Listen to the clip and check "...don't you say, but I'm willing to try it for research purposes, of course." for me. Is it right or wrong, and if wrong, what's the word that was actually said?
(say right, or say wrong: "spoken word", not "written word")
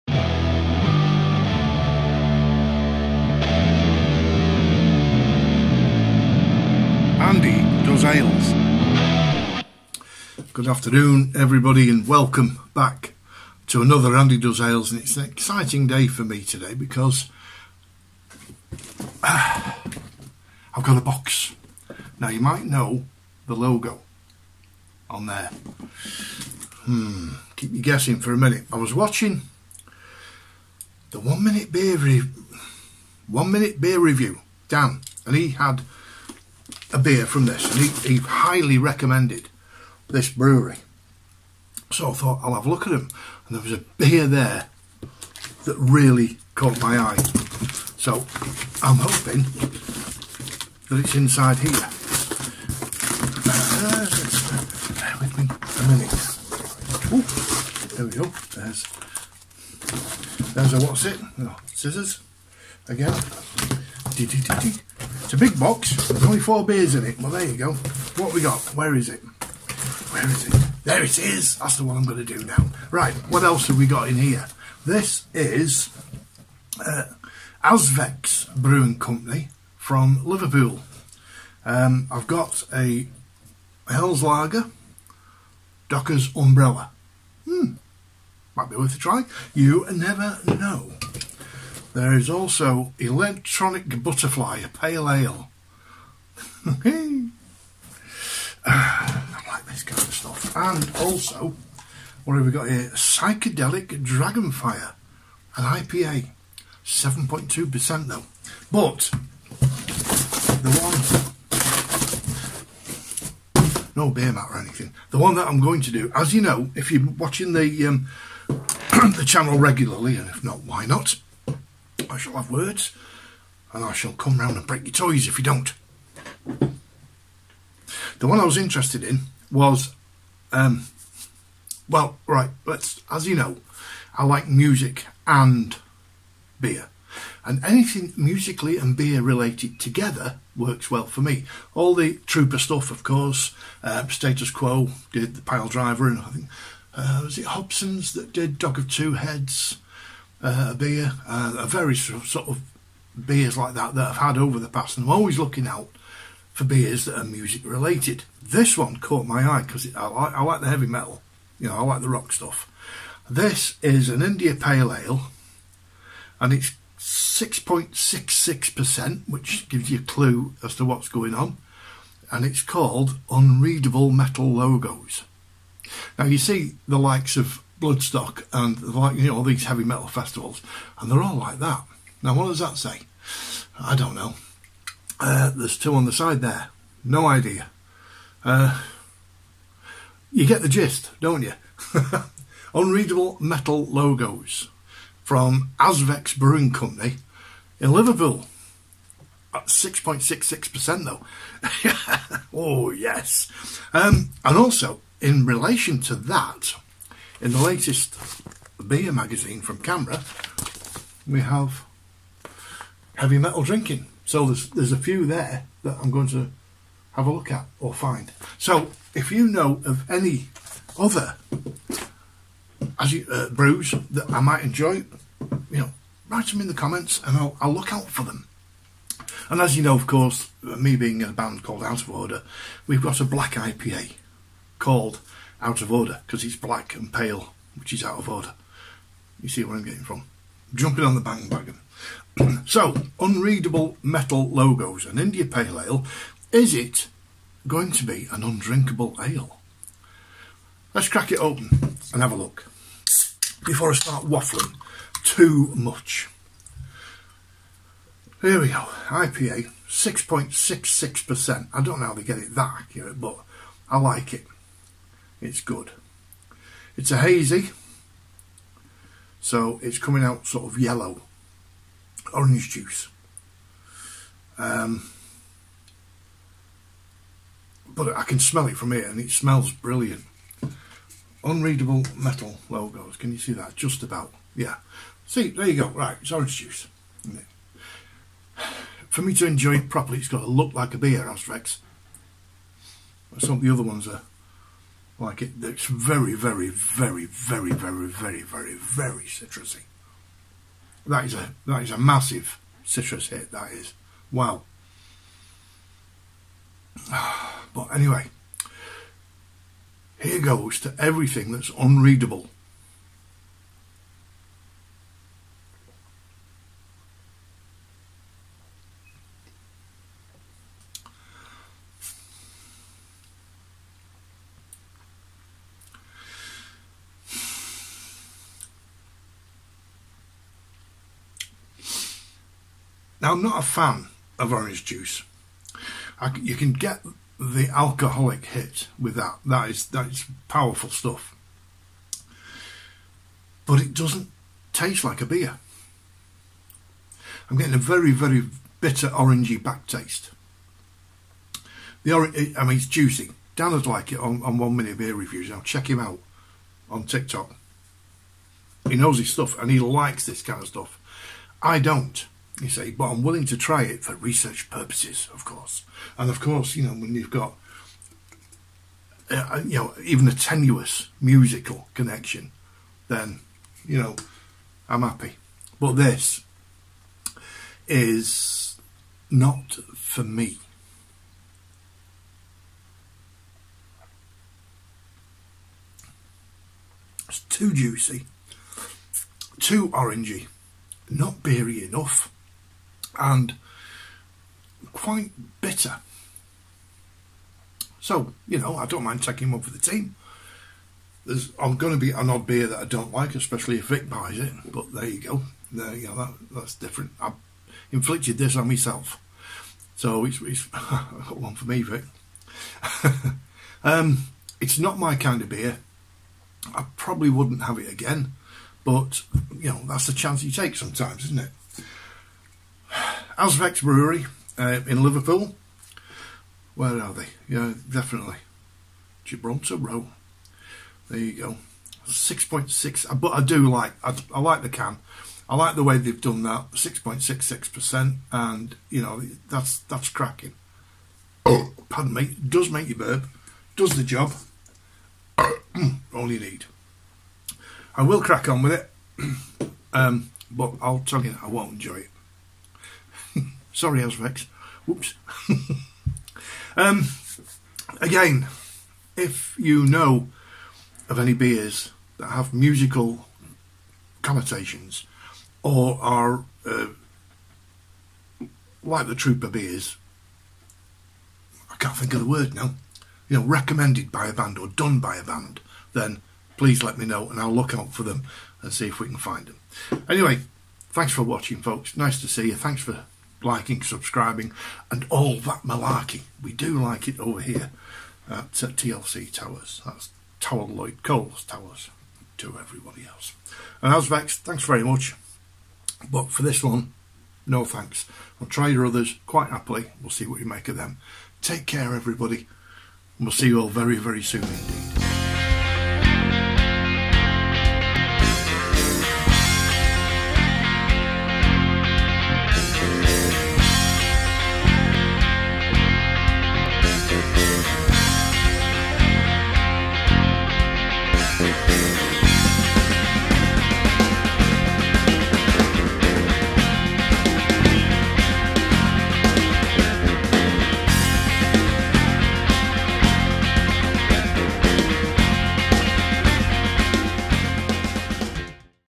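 right.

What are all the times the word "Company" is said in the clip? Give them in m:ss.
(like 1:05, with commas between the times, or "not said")
1:18, 3:16.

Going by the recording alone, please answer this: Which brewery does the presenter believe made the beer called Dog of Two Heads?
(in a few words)
Hobson's.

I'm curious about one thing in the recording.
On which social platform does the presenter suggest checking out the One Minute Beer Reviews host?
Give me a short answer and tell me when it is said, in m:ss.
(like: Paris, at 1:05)
TikTok, at 5:57.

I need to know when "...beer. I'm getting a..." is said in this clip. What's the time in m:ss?
5:45.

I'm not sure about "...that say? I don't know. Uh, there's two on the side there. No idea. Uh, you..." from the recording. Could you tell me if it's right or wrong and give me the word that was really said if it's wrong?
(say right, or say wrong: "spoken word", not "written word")
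right.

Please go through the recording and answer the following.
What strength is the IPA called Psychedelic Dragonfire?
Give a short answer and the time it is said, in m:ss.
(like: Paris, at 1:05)
7.2%, at 1:46.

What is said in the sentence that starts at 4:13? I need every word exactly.
Before I start waffling too much.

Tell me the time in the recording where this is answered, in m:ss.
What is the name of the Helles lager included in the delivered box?
1:25.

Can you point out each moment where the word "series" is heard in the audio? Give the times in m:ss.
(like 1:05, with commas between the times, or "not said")
not said.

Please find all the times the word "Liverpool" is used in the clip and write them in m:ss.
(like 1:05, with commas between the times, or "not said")
1:20, 3:17, 7:05.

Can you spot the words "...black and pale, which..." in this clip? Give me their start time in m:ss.
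3:56.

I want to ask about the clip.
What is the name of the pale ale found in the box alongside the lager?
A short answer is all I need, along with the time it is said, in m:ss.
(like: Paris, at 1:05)
Electronic Butterfly, at 1:32.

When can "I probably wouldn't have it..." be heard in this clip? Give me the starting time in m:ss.
6:56.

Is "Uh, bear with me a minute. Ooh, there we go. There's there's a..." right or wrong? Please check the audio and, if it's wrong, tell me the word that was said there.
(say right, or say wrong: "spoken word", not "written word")
right.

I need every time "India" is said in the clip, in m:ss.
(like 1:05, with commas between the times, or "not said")
2:44, 4:05.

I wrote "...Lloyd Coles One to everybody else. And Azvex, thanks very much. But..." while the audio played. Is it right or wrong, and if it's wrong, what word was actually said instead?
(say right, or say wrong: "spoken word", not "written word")
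wrong: "Towers", not "One".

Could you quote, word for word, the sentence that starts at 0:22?
Now, you might know the logo on there.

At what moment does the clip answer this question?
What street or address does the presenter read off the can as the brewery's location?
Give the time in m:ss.
7:09.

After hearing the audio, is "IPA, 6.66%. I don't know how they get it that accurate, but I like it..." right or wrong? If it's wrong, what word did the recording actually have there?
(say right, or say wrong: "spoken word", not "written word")
right.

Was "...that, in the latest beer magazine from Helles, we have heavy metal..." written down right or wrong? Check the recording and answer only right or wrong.
wrong.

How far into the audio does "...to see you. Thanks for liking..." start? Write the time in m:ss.
8:02.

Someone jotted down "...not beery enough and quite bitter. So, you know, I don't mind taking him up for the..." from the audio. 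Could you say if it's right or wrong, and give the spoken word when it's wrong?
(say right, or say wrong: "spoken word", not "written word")
right.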